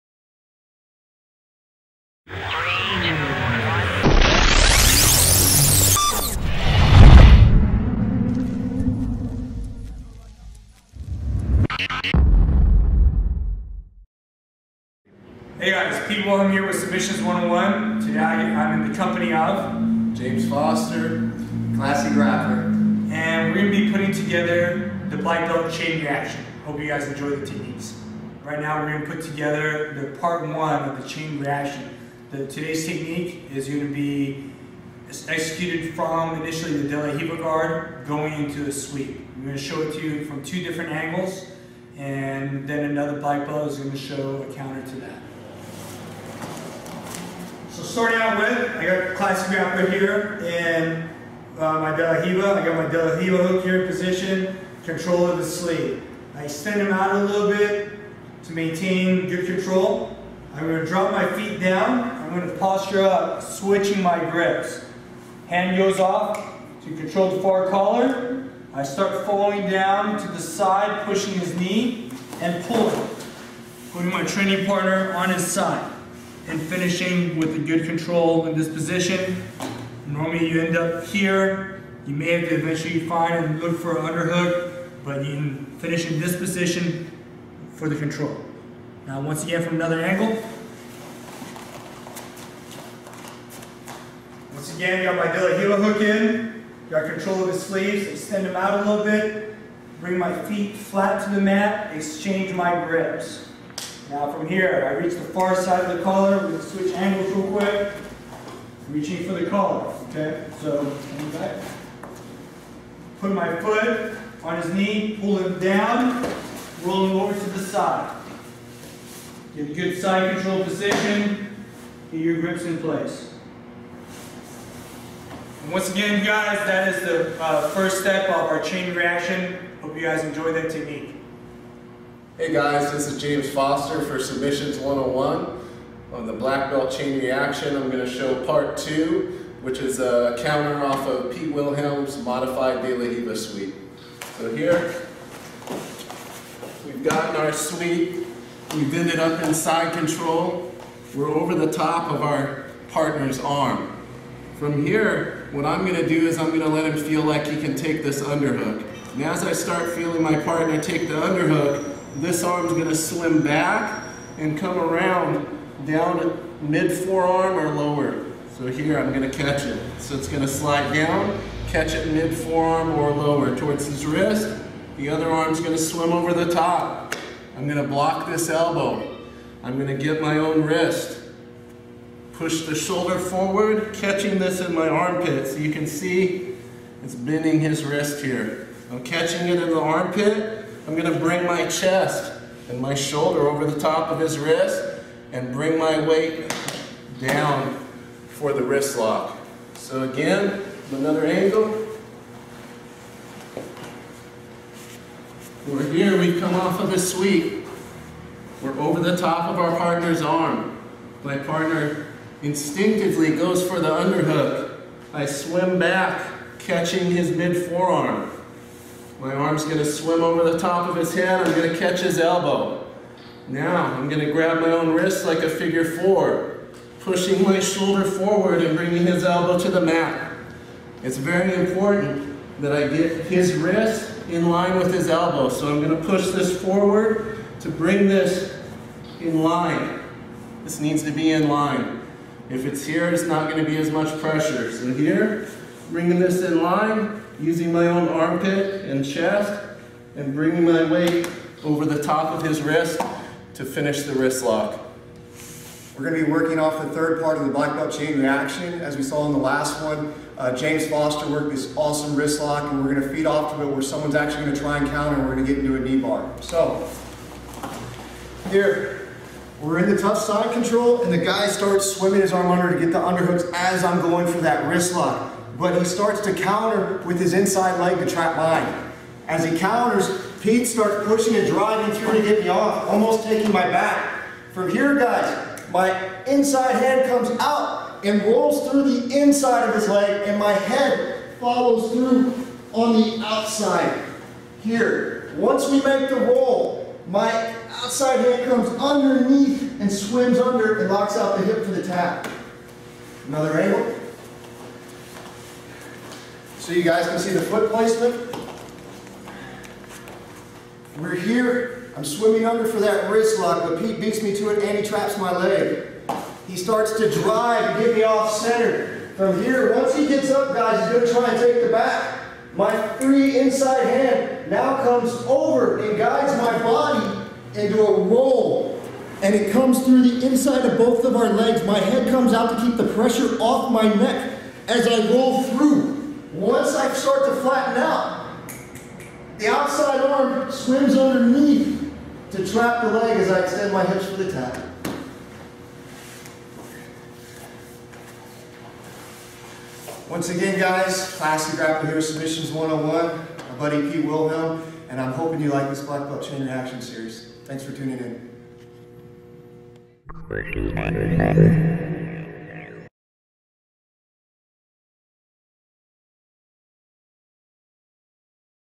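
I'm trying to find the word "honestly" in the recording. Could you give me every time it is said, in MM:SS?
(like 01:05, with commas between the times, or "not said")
not said.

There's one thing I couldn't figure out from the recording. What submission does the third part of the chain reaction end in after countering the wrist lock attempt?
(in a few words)
Knee bar.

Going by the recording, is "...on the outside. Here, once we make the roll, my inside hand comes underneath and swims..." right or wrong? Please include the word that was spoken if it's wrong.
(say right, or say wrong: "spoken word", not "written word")
wrong: "outside", not "inside".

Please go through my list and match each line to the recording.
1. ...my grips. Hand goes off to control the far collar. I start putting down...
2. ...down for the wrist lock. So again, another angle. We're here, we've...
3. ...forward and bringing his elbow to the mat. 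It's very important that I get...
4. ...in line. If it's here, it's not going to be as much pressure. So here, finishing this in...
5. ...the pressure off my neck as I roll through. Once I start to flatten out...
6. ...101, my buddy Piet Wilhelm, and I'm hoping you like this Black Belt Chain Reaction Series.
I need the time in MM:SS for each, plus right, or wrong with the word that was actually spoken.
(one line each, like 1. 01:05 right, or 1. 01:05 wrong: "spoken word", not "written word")
1. 01:04 wrong: "falling", not "putting"
2. 03:17 right
3. 03:48 right
4. 04:01 wrong: "bringing", not "finishing"
5. 05:32 right
6. 05:52 right.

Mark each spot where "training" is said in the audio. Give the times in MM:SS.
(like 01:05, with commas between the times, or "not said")
01:14.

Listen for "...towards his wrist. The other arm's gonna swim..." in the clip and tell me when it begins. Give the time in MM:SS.
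02:53.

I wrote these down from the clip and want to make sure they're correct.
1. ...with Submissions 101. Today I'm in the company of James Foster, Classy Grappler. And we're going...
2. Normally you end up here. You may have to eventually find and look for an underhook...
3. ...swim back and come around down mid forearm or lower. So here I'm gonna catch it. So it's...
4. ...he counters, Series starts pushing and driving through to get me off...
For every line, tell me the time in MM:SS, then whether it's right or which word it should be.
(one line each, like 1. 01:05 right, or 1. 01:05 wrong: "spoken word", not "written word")
1. 00:16 right
2. 01:20 right
3. 02:42 right
4. 04:39 wrong: "Piet", not "Series".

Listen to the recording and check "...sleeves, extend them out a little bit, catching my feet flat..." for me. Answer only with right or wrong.
wrong.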